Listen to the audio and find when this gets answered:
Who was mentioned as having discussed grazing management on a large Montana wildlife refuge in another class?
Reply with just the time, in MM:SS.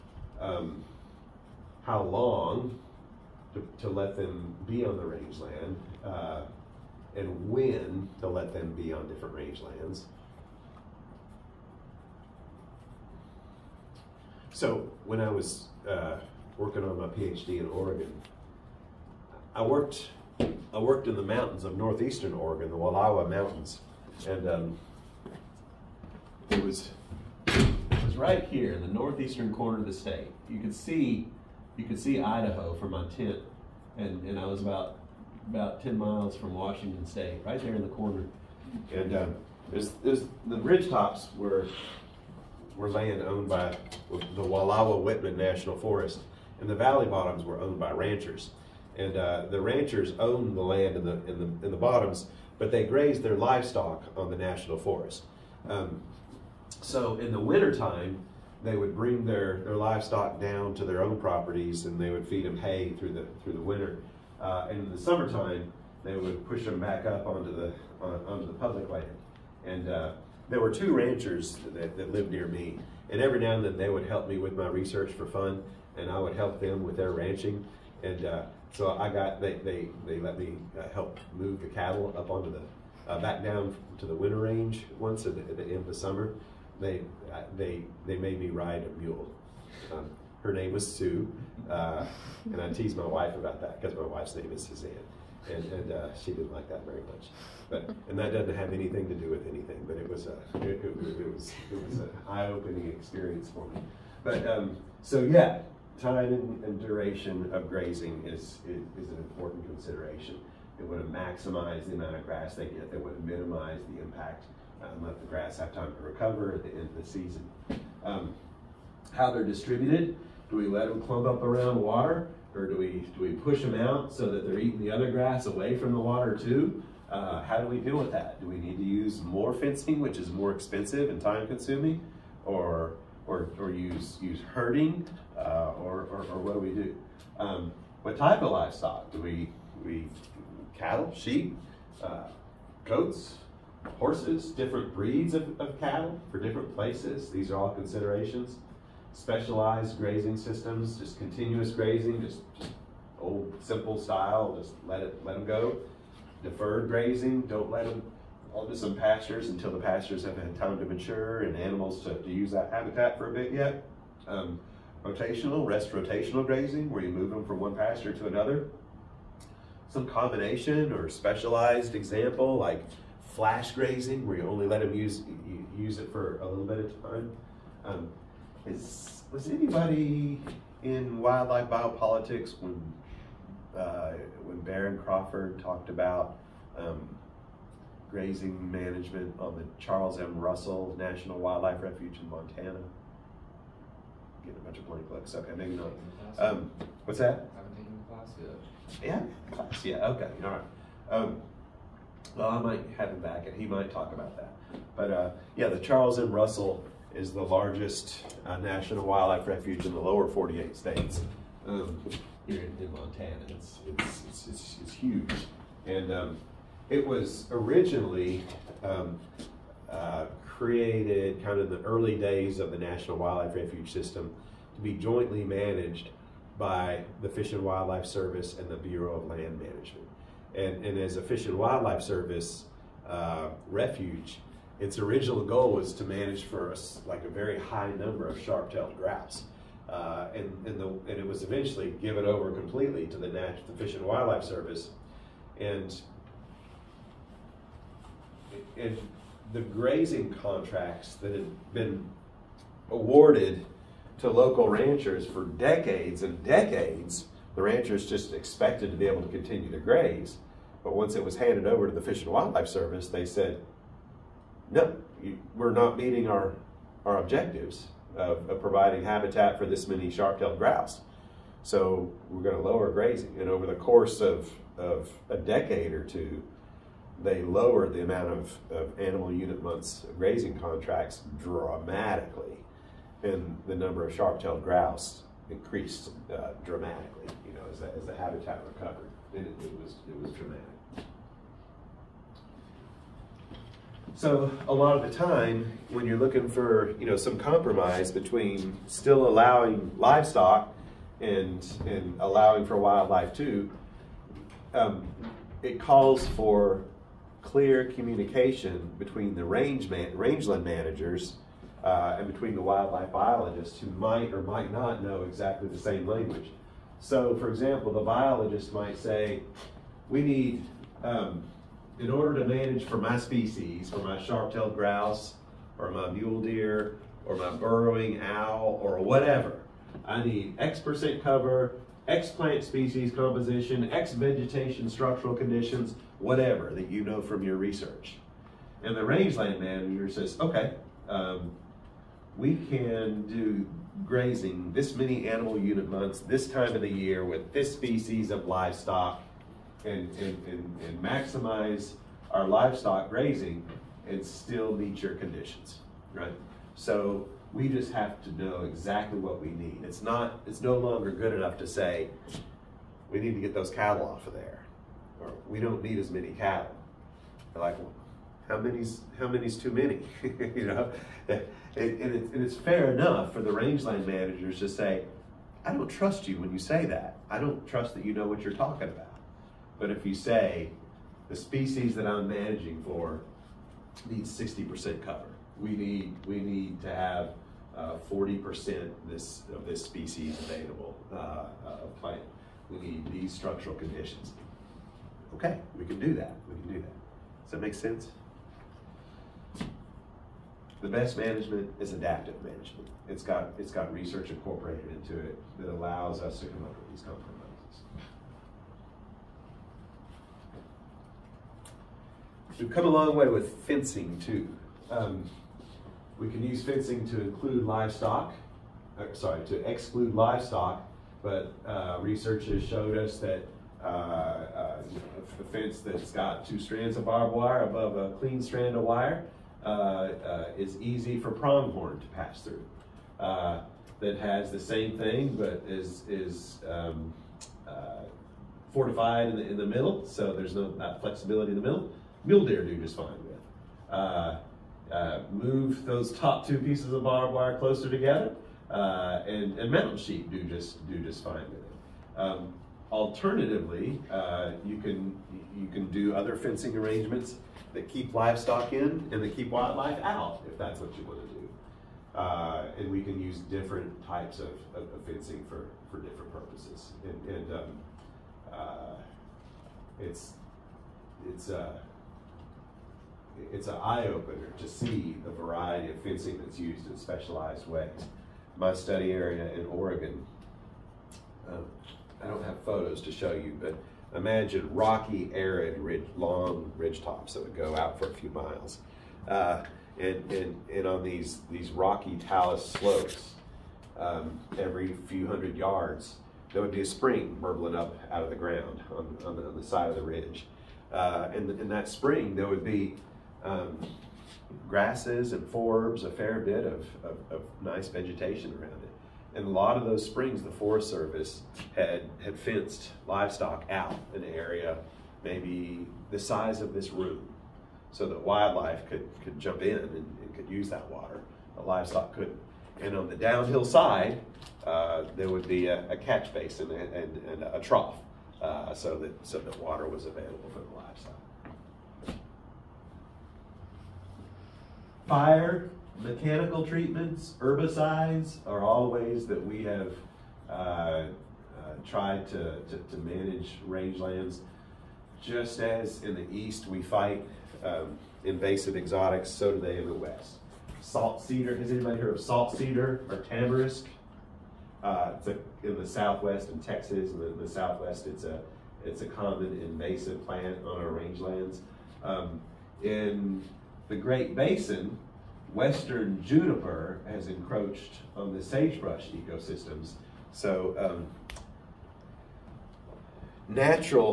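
03:04.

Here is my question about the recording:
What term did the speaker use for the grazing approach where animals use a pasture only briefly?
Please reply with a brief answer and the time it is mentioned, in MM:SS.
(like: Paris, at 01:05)
flash grazing, at 02:53.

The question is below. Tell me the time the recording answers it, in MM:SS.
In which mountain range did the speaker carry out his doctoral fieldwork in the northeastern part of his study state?
00:22.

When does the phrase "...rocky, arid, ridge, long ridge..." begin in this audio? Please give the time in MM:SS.
08:04.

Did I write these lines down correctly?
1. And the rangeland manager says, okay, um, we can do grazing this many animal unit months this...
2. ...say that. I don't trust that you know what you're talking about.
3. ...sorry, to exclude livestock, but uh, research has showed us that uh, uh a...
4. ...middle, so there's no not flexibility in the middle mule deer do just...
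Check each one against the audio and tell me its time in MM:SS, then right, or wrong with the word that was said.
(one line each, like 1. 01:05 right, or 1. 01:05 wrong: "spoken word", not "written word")
1. 05:38 right
2. 06:16 right
3. 06:59 right
4. 07:19 right.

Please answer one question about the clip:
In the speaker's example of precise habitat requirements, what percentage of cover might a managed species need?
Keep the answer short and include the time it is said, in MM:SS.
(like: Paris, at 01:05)
60%, at 06:24.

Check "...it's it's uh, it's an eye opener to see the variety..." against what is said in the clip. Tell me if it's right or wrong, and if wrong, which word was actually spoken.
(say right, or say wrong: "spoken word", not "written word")
right.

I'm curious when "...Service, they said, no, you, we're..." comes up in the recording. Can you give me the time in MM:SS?
04:22.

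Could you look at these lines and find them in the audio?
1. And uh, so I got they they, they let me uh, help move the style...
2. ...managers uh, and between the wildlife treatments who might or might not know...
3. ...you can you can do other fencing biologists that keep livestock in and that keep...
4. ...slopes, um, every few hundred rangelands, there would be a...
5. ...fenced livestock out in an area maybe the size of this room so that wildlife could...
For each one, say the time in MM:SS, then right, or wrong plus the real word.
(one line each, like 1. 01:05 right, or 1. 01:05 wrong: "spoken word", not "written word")
1. 01:18 wrong: "cattle", not "style"
2. 05:10 wrong: "biologists", not "treatments"
3. 07:34 wrong: "arrangements", not "biologists"
4. 08:12 wrong: "yards", not "rangelands"
5. 08:32 right.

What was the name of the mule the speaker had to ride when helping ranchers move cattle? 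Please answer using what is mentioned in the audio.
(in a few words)
Sue.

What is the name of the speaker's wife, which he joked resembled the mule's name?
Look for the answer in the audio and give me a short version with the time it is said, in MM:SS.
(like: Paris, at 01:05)
Suzanne, at 01:34.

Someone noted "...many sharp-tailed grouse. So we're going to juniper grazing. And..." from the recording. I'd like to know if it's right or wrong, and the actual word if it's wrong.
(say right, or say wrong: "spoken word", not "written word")
wrong: "lower", not "juniper".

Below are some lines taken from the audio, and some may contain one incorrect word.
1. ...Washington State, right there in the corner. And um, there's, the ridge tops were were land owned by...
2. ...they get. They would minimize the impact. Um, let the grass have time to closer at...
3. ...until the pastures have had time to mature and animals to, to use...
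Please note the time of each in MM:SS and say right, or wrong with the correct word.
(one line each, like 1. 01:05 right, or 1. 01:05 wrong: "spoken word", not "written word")
1. 00:36 right
2. 01:52 wrong: "recover", not "closer"
3. 02:39 right.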